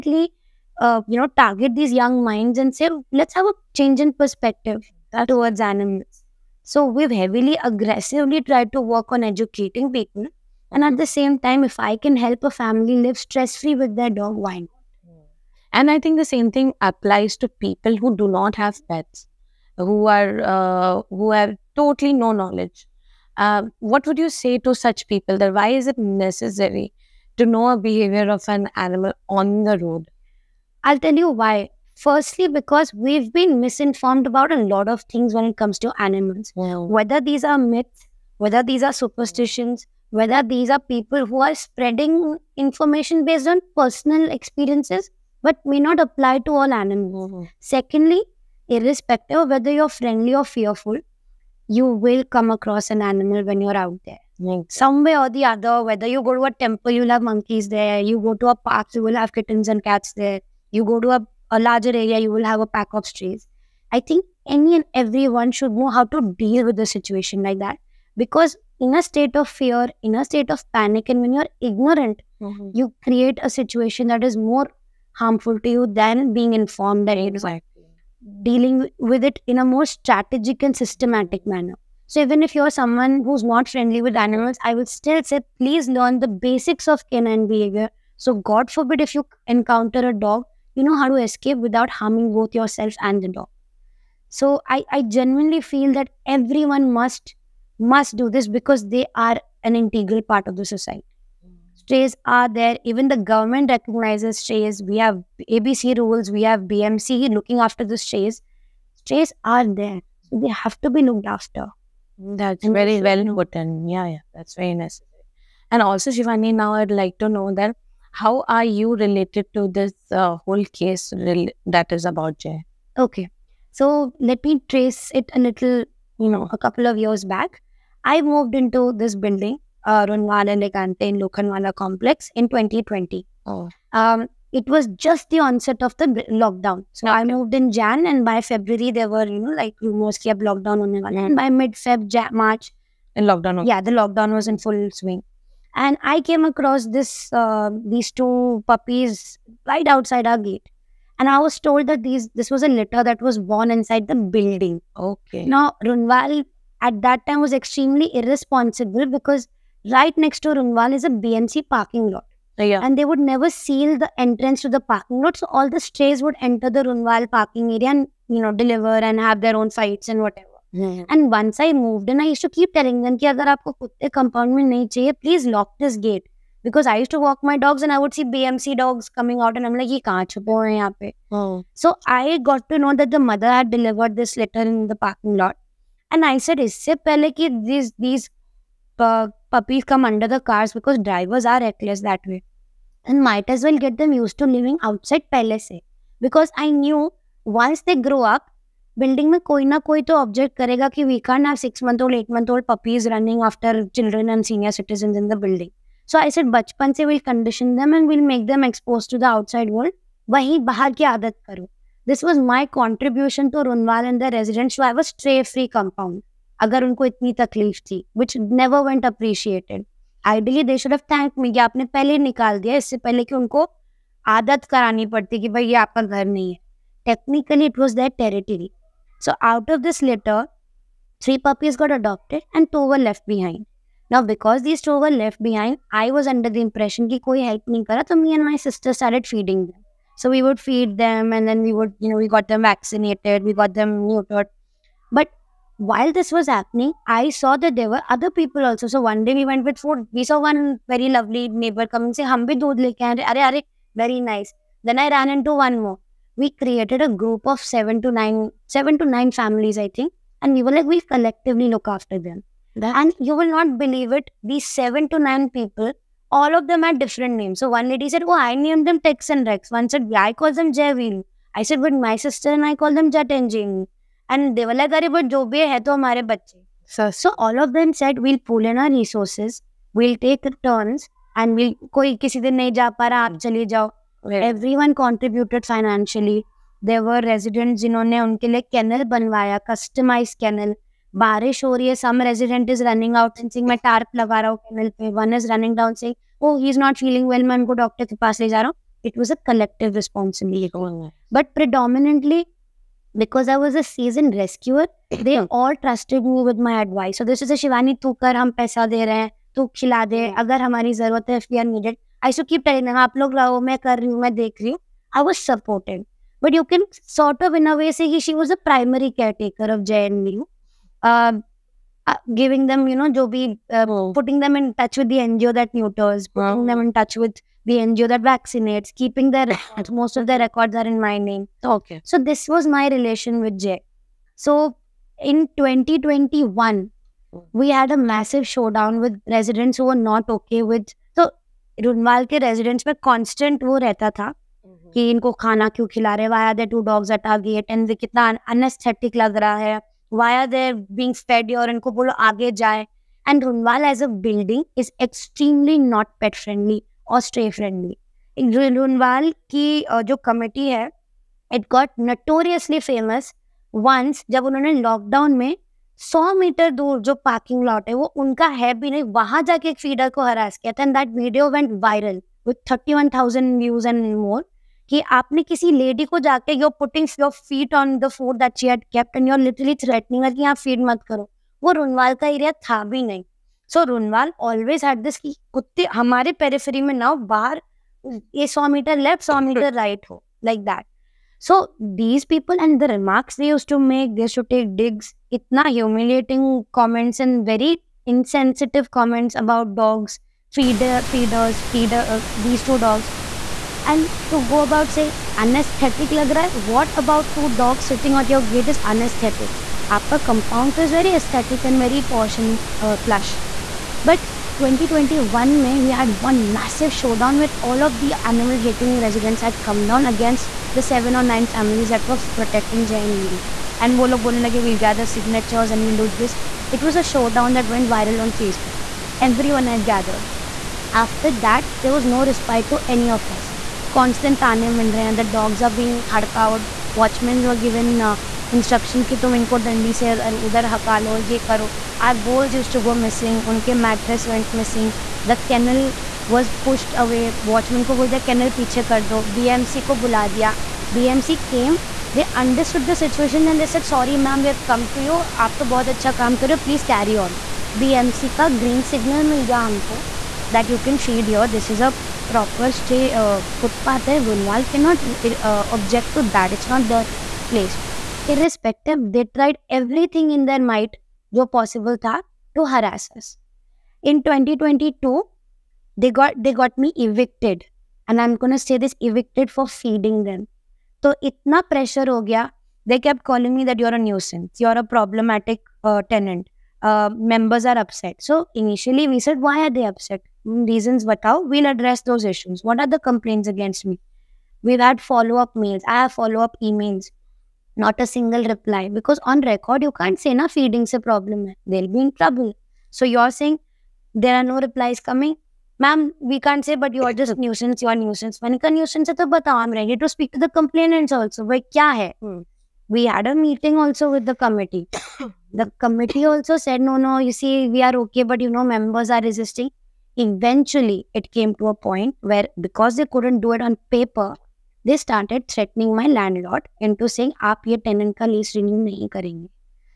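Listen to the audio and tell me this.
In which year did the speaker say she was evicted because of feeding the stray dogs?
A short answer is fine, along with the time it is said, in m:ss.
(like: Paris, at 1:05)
2022, at 7:54.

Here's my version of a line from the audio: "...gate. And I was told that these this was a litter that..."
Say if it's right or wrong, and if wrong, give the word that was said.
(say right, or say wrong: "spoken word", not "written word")
right.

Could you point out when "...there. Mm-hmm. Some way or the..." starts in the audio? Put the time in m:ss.
0:54.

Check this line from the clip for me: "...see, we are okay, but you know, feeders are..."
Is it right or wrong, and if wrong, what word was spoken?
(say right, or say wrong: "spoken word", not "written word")
wrong: "members", not "feeders".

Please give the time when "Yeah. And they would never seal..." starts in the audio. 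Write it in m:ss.
2:42.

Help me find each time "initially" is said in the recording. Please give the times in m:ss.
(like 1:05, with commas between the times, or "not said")
8:08.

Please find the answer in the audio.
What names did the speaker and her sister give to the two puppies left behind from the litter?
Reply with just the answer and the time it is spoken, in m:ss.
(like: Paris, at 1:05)
Jet and Jamie, at 4:33.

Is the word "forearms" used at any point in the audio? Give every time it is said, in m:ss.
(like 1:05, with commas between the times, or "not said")
not said.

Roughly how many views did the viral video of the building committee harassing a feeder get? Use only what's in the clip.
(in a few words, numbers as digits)
31,000.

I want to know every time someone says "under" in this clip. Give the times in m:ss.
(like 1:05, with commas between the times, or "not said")
3:10, 3:56.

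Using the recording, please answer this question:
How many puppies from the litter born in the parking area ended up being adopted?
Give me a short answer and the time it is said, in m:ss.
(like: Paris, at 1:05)
three, at 3:51.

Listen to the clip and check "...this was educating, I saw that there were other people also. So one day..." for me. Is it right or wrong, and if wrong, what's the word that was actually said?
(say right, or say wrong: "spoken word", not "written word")
wrong: "happening", not "educating".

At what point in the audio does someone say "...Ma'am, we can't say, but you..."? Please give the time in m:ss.
8:25.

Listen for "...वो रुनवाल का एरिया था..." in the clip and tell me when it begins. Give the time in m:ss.
6:21.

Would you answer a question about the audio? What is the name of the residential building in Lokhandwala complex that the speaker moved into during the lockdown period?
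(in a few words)
Runwal Elegante.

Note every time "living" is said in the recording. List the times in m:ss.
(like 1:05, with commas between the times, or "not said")
3:14.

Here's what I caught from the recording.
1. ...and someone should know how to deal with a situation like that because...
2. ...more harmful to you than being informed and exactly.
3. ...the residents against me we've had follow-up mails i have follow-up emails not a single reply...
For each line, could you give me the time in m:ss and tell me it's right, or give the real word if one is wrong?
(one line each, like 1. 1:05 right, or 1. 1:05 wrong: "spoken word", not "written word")
1. 1:04 wrong: "everyone", not "someone"
2. 1:14 right
3. 8:12 wrong: "complaints", not "residents".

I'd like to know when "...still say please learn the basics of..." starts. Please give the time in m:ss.
1:24.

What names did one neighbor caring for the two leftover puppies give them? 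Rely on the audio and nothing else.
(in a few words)
Tex and Rex.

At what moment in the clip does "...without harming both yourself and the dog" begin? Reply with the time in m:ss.
1:31.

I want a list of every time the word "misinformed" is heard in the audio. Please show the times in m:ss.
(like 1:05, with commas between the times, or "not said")
0:33.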